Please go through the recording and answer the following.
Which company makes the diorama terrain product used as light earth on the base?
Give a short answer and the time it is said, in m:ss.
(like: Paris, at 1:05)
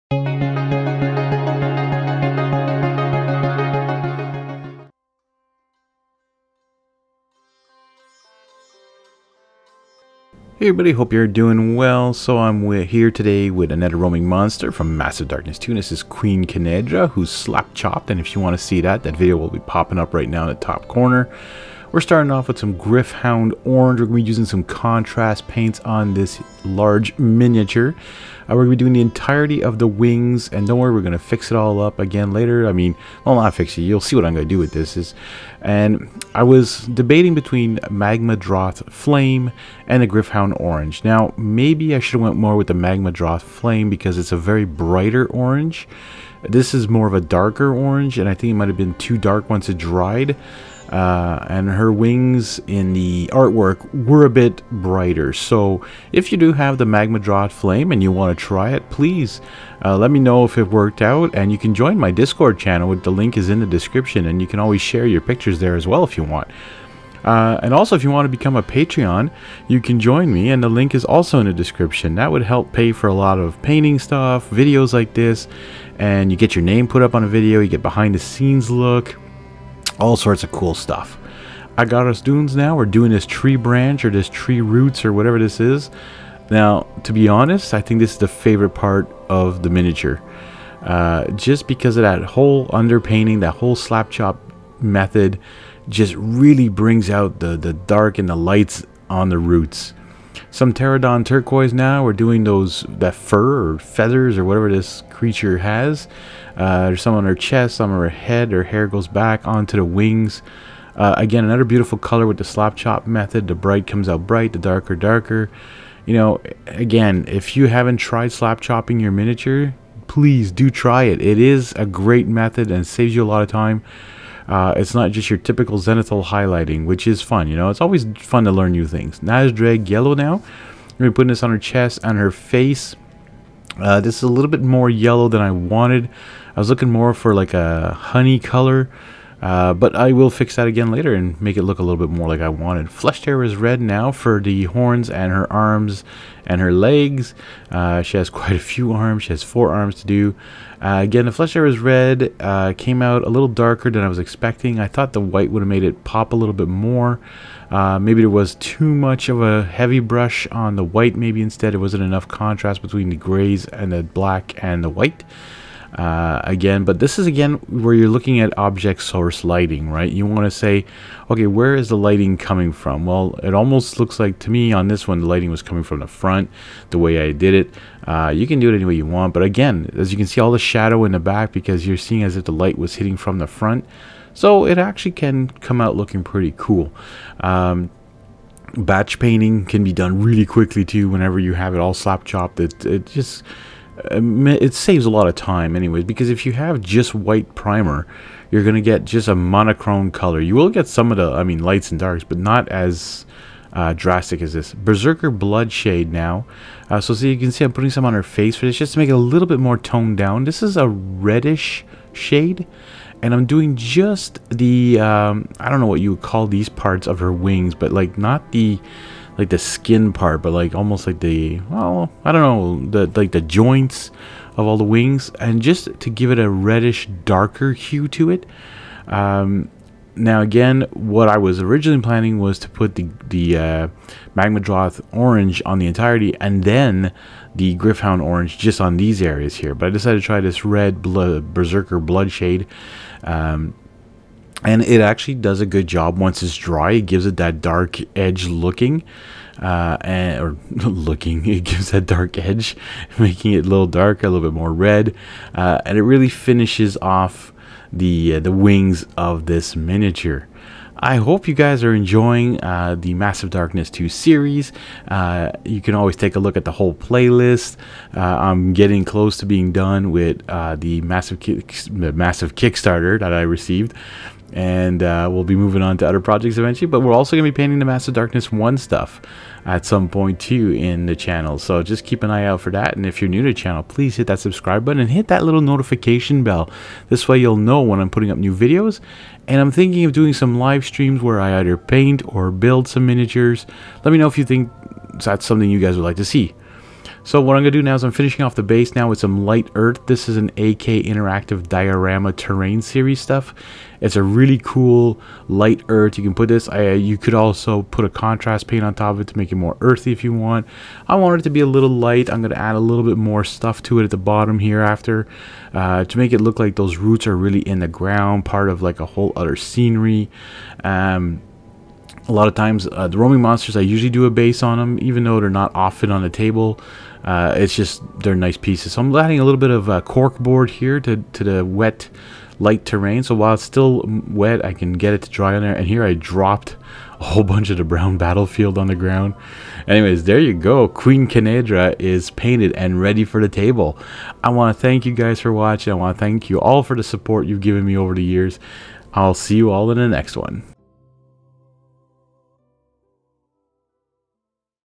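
AK Interactive, at 5:00.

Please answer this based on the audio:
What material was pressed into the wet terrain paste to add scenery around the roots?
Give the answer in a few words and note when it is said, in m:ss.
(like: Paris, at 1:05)
Cork board, at 5:30.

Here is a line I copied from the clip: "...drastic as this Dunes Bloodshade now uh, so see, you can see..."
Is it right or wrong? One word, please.
wrong.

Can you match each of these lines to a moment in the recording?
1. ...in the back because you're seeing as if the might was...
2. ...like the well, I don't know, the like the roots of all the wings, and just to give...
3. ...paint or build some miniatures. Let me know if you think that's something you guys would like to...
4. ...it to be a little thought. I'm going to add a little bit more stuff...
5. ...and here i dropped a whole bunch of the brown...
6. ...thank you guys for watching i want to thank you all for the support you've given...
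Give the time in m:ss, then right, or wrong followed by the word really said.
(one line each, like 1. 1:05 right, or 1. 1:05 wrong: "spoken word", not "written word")
1. 3:01 wrong: "light", not "might"
2. 3:41 wrong: "joints", not "roots"
3. 4:51 right
4. 5:11 wrong: "light", not "thought"
5. 5:35 right
6. 5:44 right.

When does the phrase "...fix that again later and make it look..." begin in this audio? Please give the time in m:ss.
2:20.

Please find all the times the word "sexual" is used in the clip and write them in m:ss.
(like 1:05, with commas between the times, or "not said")
not said.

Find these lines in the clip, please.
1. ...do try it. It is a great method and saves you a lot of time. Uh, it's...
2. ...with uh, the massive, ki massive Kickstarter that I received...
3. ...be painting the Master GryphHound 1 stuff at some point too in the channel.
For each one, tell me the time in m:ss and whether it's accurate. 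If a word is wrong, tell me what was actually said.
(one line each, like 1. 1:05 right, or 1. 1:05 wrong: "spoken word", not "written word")
1. 2:00 right
2. 4:30 right
3. 4:37 wrong: "Darkness", not "GryphHound".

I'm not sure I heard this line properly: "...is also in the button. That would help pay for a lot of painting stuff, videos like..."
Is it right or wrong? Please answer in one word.
wrong.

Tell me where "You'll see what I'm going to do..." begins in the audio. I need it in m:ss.
0:33.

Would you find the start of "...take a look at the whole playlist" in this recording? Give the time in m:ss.
4:26.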